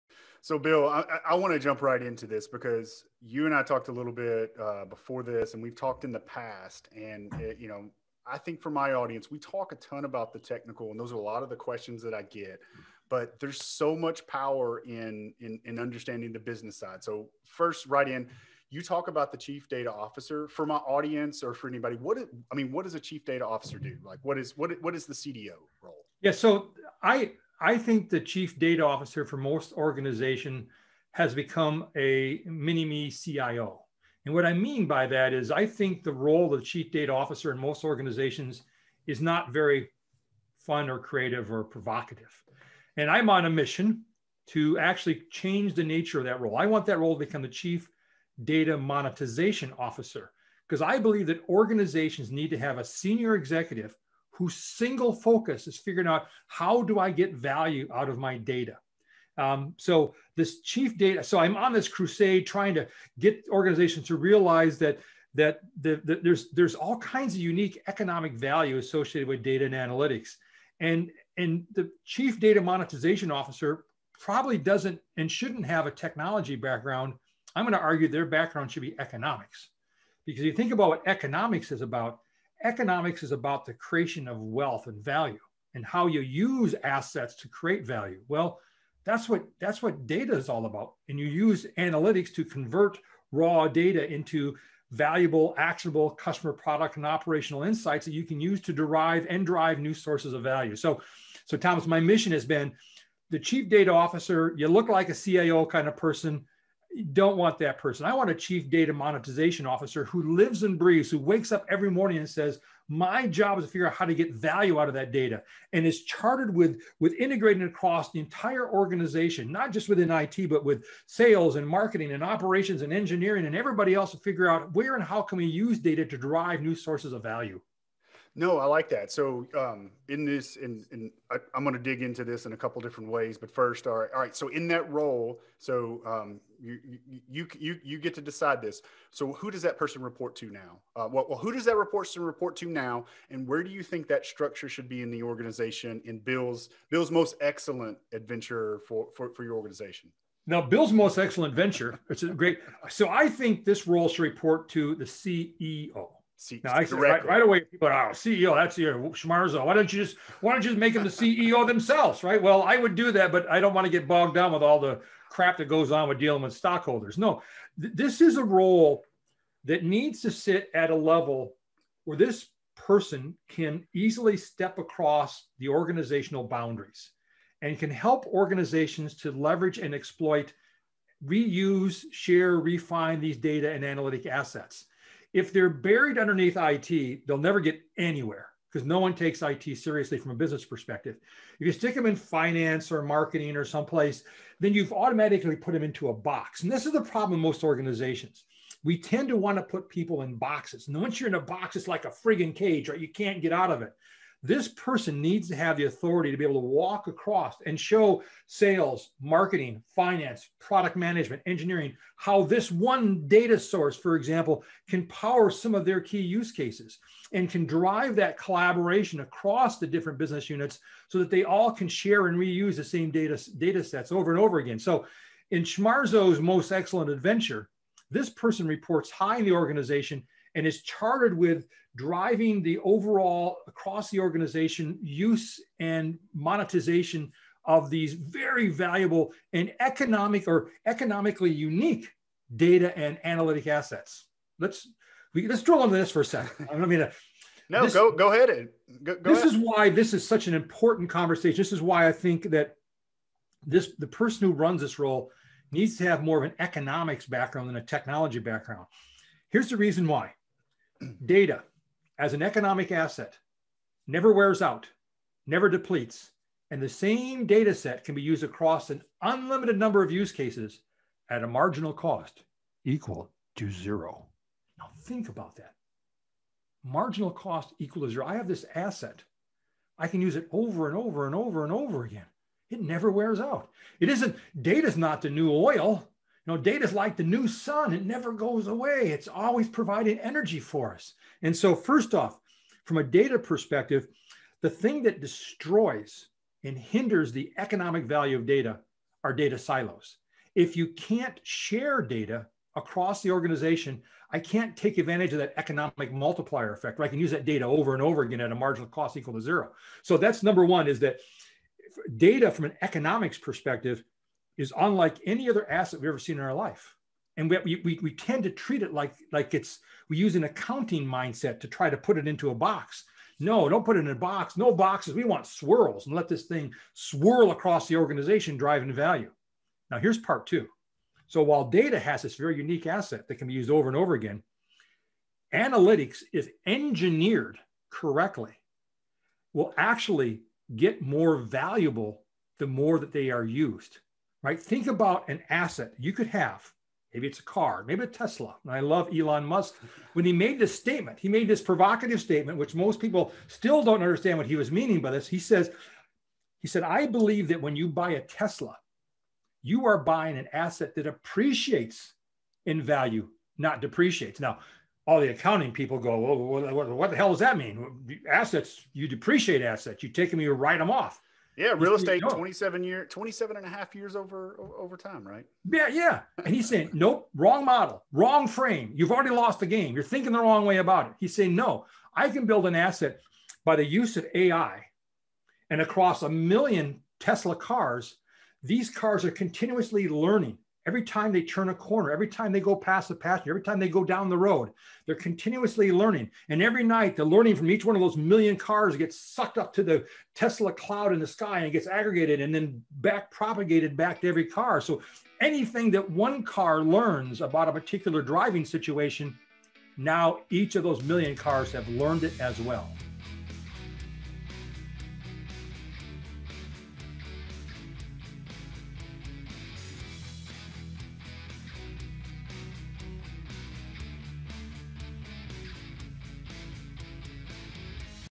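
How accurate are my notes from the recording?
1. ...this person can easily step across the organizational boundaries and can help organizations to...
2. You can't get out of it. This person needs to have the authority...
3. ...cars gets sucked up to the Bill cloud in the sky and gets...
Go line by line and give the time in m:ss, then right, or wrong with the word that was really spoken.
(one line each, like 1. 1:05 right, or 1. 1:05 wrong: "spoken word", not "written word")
1. 2:52 right
2. 3:22 right
3. 6:38 wrong: "Tesla", not "Bill".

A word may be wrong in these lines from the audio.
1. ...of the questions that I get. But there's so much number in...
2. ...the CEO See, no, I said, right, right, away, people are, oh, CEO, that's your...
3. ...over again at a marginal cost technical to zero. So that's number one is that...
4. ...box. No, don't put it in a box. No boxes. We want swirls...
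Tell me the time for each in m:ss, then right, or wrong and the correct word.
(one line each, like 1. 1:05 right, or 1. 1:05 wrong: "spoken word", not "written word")
1. 0:11 wrong: "power", not "number"
2. 2:34 right
3. 5:08 wrong: "equal", not "technical"
4. 5:22 right.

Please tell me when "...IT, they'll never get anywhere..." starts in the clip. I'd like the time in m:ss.
3:06.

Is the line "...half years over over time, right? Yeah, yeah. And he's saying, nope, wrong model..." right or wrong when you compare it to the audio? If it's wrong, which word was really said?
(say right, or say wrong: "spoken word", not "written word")
right.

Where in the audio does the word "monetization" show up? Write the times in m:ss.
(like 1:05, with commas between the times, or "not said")
0:48, 1:12, 1:48, 3:56.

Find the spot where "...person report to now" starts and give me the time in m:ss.
2:19.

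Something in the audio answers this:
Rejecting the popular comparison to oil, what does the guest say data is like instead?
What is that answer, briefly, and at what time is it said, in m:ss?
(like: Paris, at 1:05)
The new sun, at 4:47.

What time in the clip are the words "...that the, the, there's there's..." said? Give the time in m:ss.
1:05.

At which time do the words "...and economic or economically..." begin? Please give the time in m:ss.
3:59.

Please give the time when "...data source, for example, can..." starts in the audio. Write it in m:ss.
3:33.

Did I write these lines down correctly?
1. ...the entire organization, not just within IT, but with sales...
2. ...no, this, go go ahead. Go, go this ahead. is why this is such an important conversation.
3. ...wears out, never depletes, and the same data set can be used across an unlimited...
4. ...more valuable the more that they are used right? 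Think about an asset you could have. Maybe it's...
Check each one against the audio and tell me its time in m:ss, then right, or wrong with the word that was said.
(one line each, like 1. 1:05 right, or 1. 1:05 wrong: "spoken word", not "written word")
1. 1:58 right
2. 4:07 right
3. 4:24 right
4. 5:41 right.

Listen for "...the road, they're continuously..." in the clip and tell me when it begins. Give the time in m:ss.
6:34.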